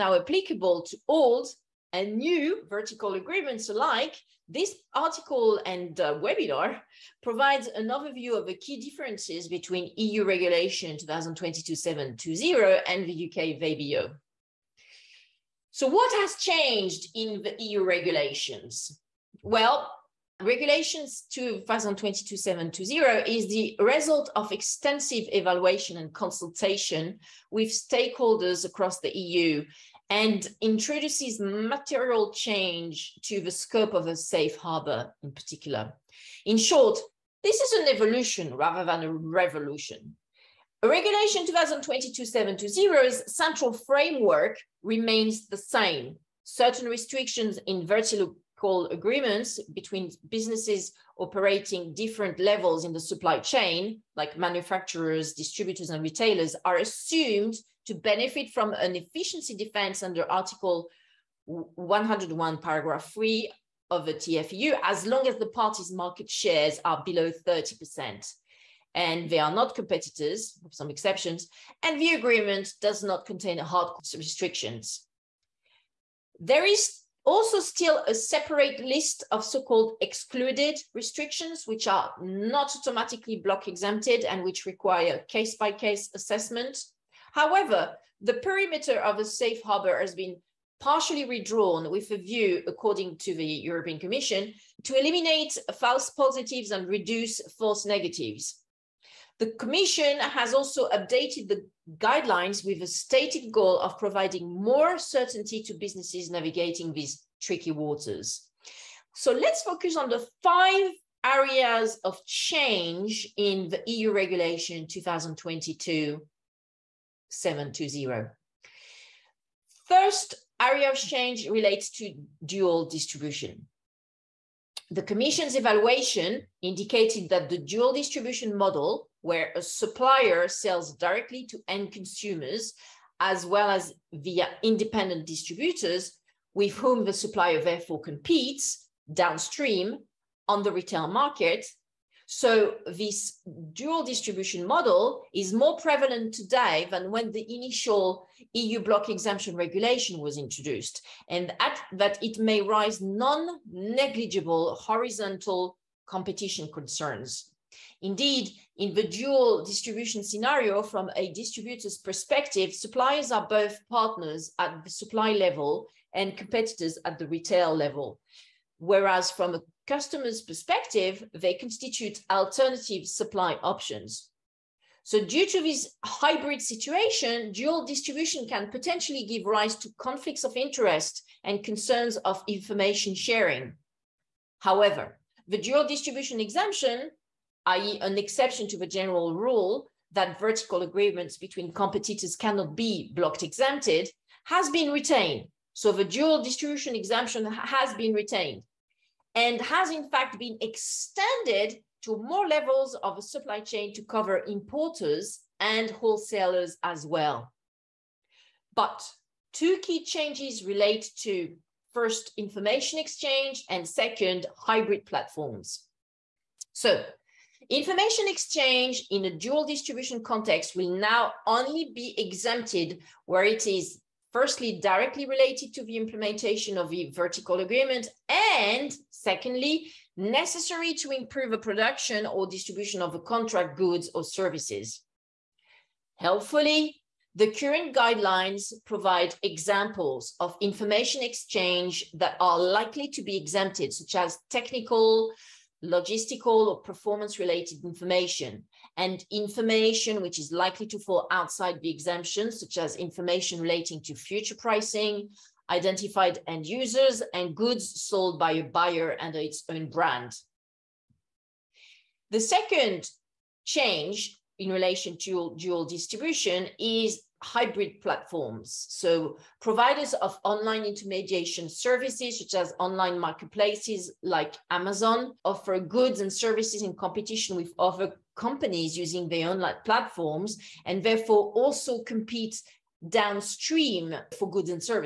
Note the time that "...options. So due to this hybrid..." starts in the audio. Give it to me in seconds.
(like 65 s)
173 s.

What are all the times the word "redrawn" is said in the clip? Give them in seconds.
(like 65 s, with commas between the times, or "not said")
91 s.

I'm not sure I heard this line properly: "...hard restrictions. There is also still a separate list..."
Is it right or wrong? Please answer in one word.
right.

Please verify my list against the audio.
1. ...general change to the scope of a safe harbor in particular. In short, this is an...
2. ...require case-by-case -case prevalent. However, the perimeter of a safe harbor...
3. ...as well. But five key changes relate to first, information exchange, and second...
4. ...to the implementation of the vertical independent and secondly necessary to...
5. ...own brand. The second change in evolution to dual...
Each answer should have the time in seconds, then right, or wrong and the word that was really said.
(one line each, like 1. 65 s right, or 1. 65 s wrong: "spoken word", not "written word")
1. 31 s wrong: "material", not "general"
2. 84 s wrong: "assessment", not "prevalent"
3. 206 s wrong: "two", not "five"
4. 225 s wrong: "agreement", not "independent"
5. 259 s wrong: "relation", not "evolution".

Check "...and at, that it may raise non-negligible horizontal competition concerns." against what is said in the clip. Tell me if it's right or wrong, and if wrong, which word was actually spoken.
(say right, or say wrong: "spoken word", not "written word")
right.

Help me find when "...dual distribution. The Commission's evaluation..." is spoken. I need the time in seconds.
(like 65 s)
122 s.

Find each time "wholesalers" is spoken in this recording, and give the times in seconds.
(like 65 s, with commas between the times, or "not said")
205 s.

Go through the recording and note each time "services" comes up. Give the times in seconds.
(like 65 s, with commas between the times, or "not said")
234 s, 271 s, 276 s.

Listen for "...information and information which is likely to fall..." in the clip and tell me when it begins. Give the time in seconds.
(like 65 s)
247 s.